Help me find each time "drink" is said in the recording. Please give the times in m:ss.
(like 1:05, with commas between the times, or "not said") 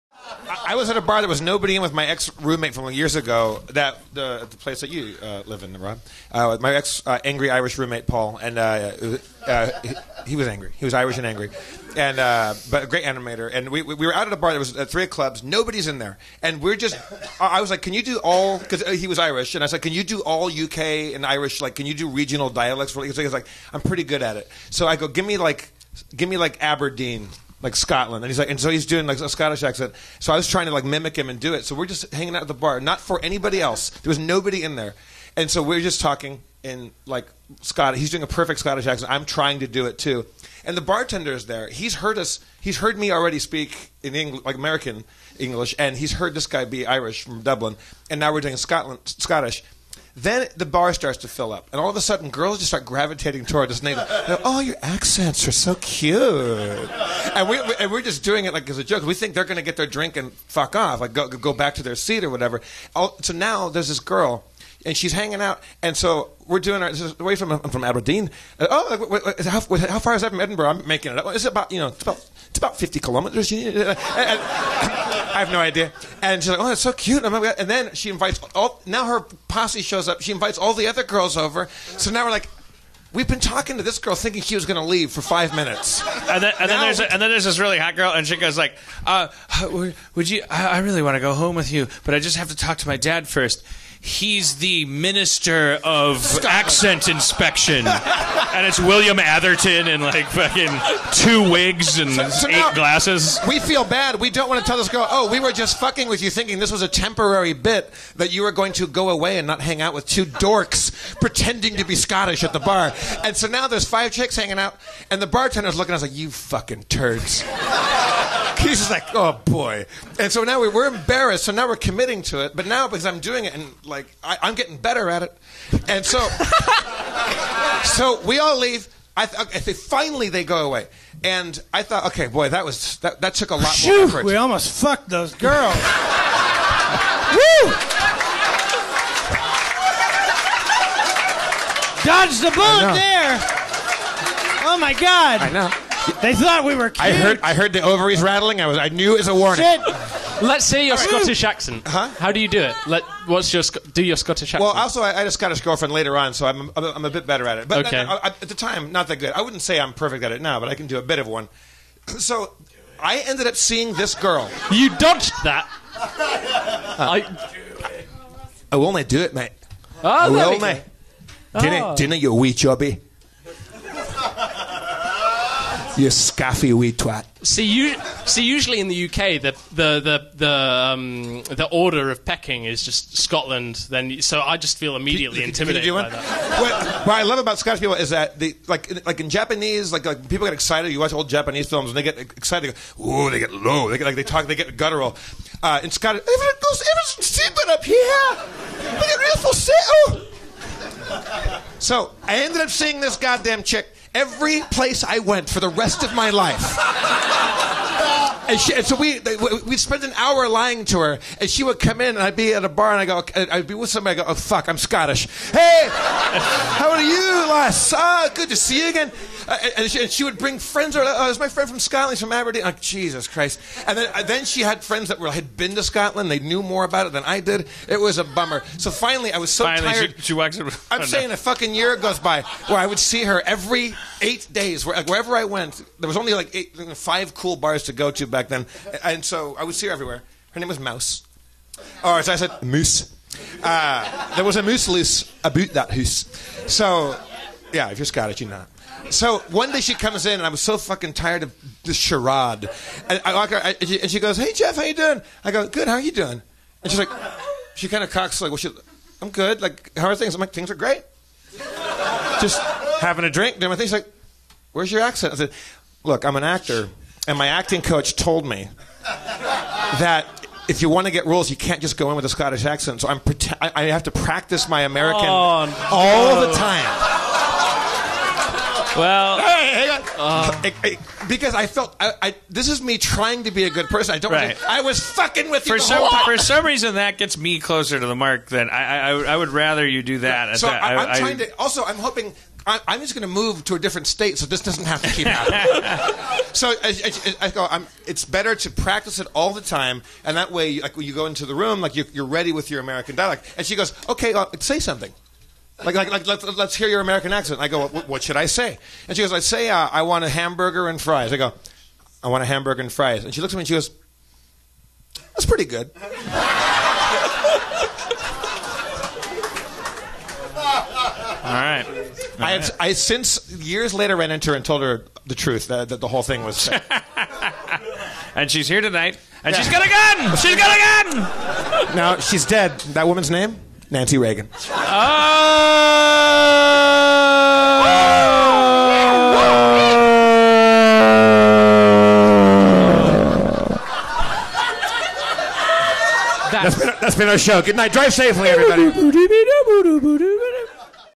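0:59, 4:23.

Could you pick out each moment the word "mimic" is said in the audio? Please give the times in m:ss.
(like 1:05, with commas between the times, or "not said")
0:30.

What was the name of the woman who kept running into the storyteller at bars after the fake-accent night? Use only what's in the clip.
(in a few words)
Mouse.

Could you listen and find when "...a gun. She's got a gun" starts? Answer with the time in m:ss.
5:29.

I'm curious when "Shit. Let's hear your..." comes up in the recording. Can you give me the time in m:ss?
2:29.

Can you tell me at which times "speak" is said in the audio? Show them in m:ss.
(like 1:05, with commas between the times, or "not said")
0:43.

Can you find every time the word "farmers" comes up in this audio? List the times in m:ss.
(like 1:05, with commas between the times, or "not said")
not said.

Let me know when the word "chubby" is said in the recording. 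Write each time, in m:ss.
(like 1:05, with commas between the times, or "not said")
2:52.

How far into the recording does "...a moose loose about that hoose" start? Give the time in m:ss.
4:04.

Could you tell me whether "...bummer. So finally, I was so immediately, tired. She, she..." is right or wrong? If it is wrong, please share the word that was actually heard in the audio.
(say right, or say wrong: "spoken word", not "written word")
wrong: "finally", not "immediately".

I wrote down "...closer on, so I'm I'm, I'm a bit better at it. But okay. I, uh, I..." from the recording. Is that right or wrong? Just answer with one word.
wrong.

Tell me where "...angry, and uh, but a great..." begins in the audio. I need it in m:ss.
0:11.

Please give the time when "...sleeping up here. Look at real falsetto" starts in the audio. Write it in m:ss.
3:17.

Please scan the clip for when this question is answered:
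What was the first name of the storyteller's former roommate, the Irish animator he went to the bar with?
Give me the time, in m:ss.
0:08.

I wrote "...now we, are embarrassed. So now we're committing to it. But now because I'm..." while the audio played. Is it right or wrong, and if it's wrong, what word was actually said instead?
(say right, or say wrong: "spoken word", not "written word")
right.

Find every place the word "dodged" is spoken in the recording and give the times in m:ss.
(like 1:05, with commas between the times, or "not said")
2:22, 2:44.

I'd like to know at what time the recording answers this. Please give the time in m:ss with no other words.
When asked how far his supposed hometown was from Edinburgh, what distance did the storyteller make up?
1:12.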